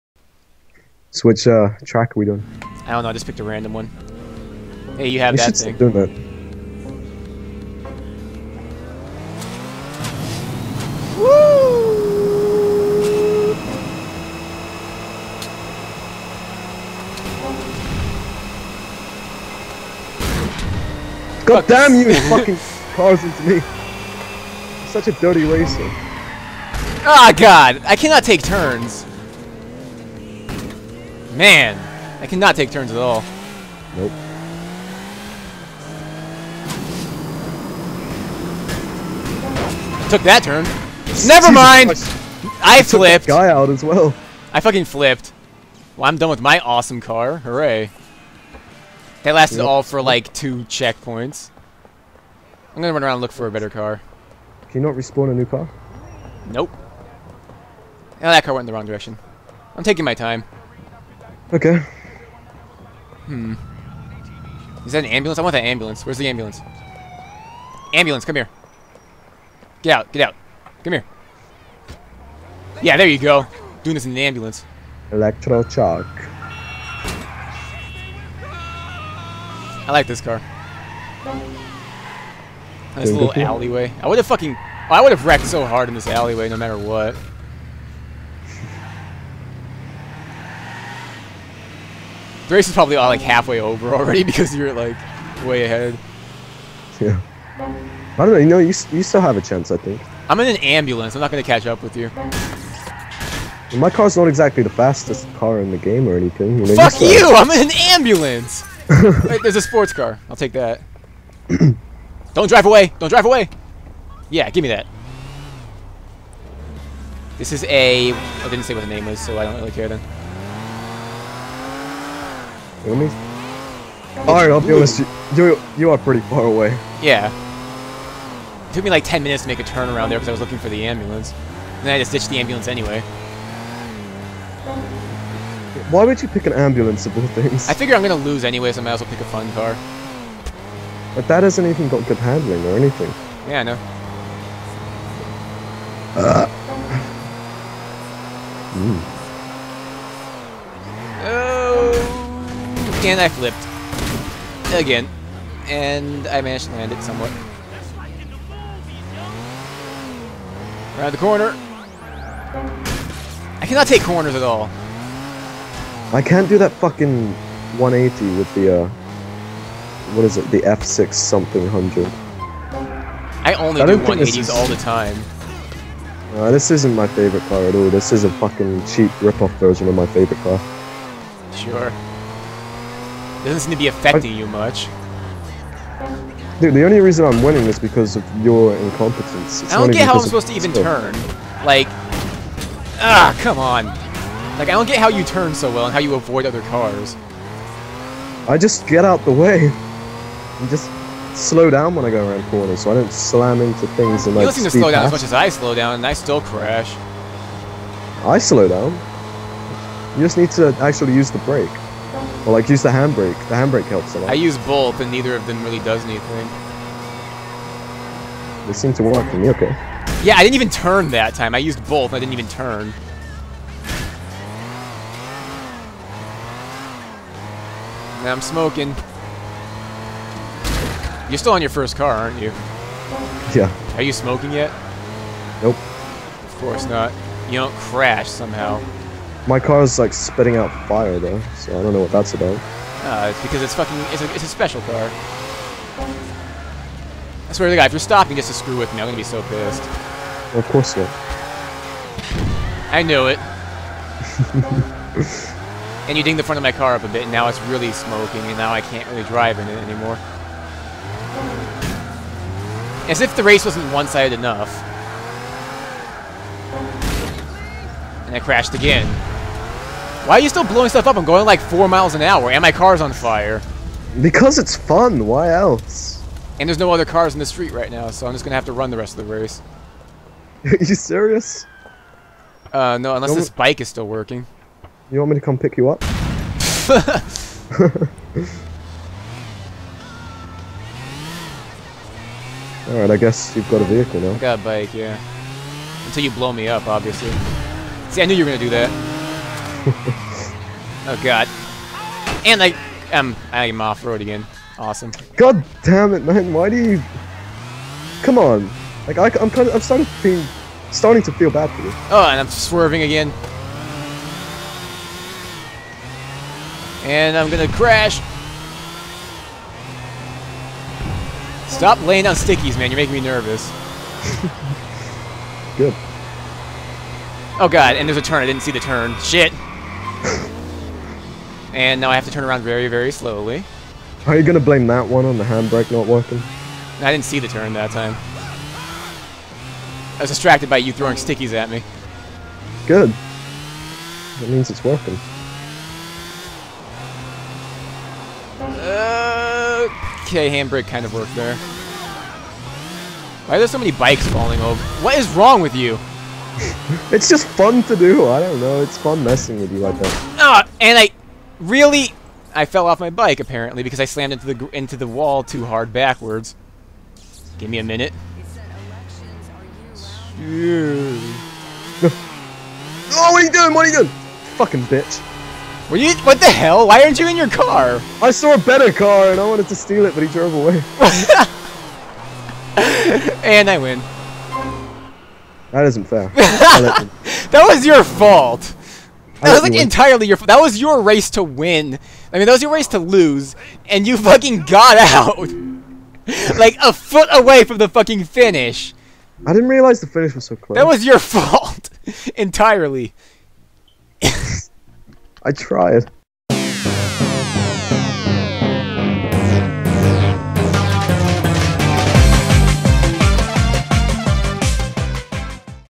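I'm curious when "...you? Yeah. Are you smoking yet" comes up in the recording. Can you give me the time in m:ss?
3:52.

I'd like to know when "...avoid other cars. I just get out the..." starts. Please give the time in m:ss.
3:16.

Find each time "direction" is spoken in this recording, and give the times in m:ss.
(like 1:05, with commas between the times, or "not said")
0:58.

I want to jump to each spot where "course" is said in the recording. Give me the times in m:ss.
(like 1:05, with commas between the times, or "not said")
3:56, 4:10.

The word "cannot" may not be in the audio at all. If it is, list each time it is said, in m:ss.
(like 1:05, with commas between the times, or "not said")
0:27, 0:32, 2:43.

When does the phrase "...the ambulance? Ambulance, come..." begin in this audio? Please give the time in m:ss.
1:06.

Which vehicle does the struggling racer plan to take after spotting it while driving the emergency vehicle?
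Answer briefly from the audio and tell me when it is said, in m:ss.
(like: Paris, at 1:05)
sports car, at 1:49.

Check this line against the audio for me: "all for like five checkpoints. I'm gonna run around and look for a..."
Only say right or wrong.
wrong.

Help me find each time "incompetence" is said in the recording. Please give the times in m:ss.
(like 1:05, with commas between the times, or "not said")
3:08.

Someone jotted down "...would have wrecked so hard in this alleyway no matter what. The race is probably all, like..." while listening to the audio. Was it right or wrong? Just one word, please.
right.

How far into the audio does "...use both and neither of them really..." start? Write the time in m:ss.
3:34.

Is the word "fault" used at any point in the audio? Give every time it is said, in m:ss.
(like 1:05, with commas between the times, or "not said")
6:28, 6:41.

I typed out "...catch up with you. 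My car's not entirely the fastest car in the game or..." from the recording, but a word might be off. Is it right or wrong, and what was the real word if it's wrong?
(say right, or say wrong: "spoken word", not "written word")
wrong: "exactly", not "entirely".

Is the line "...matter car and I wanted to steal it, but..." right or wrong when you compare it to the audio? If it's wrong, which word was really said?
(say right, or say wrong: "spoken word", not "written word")
wrong: "better", not "matter".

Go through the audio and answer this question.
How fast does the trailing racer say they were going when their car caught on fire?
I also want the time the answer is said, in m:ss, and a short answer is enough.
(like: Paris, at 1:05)
4 miles an hour, at 4:31.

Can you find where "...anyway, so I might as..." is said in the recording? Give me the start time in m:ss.
2:18.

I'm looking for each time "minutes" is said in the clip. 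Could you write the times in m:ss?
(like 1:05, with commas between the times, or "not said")
2:09, 6:07.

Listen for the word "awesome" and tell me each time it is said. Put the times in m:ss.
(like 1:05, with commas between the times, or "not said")
0:46, 5:04.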